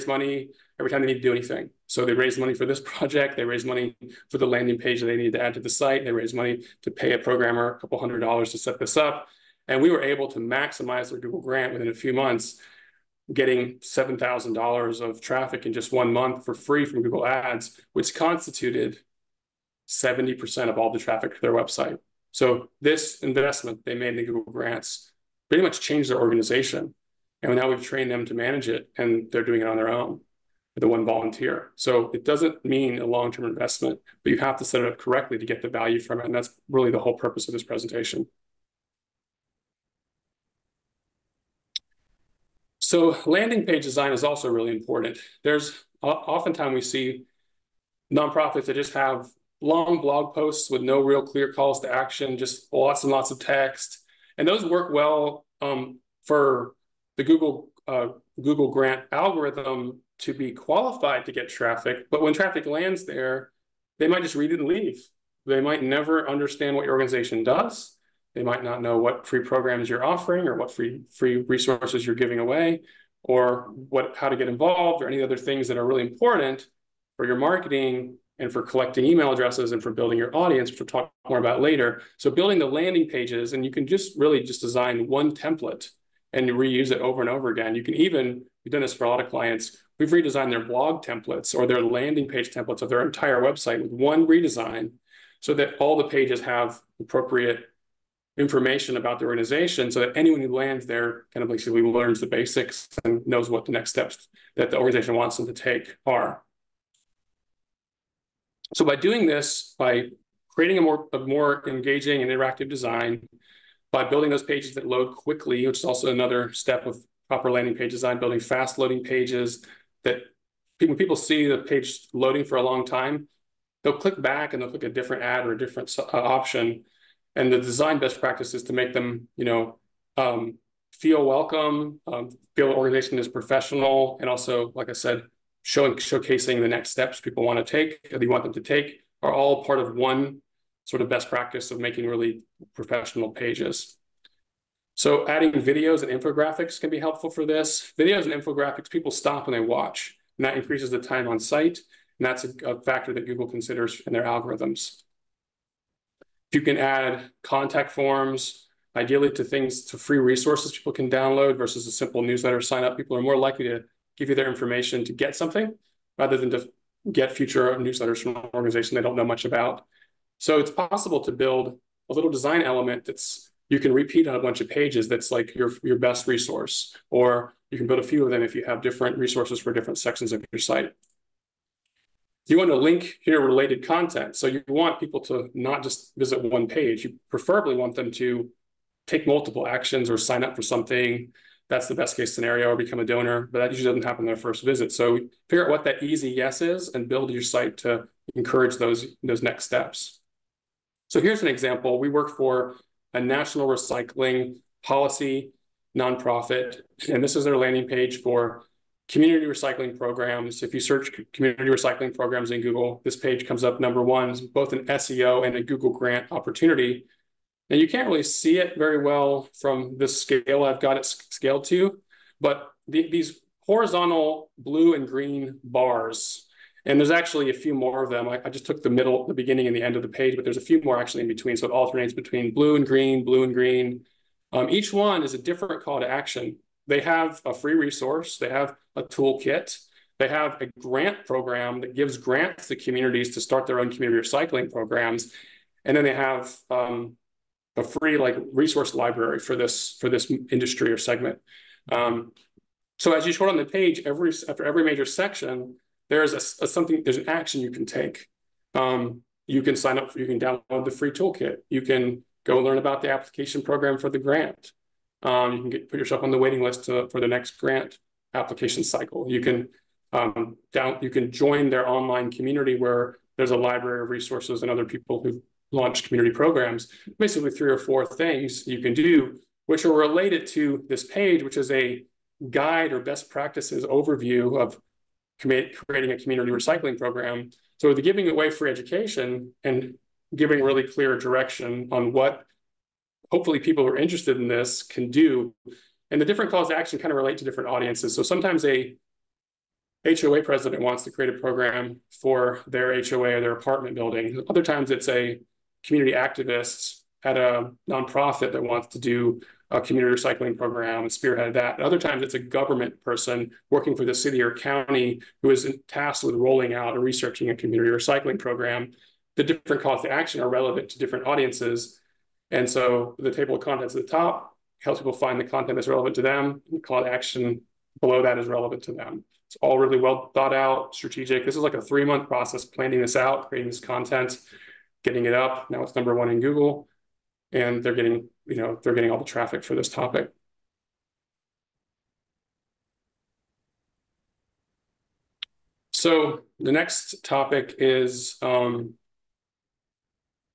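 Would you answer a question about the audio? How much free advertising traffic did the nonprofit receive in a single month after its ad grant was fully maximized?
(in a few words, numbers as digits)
$7,000.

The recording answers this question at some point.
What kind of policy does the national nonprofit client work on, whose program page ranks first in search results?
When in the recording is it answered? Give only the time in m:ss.
3:23.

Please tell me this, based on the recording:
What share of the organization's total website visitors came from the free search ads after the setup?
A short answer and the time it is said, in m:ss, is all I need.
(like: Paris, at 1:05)
70%, at 0:19.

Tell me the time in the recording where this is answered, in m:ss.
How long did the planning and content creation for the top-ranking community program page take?
5:31.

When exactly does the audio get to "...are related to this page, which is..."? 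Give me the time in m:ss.
4:39.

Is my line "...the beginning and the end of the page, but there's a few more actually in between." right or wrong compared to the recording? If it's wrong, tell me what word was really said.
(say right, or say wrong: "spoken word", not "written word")
right.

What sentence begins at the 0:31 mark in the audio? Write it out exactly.
So it doesn't mean a long-term investment, but you have to set it up correctly to get the value from it.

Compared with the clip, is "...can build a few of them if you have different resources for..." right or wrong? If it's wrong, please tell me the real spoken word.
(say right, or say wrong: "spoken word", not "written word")
right.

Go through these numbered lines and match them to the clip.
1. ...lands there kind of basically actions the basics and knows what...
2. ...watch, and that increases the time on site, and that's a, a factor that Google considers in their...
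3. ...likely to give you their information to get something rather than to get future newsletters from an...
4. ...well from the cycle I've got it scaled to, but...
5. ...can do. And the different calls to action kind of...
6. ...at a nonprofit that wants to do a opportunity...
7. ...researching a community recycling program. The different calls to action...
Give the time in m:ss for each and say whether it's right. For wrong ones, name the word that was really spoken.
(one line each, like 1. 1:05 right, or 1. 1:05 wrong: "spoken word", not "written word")
1. 1:40 wrong: "learns", not "actions"
2. 2:29 right
3. 2:43 right
4. 3:38 wrong: "scale", not "cycle"
5. 4:54 right
6. 5:07 wrong: "community", not "opportunity"
7. 5:17 right.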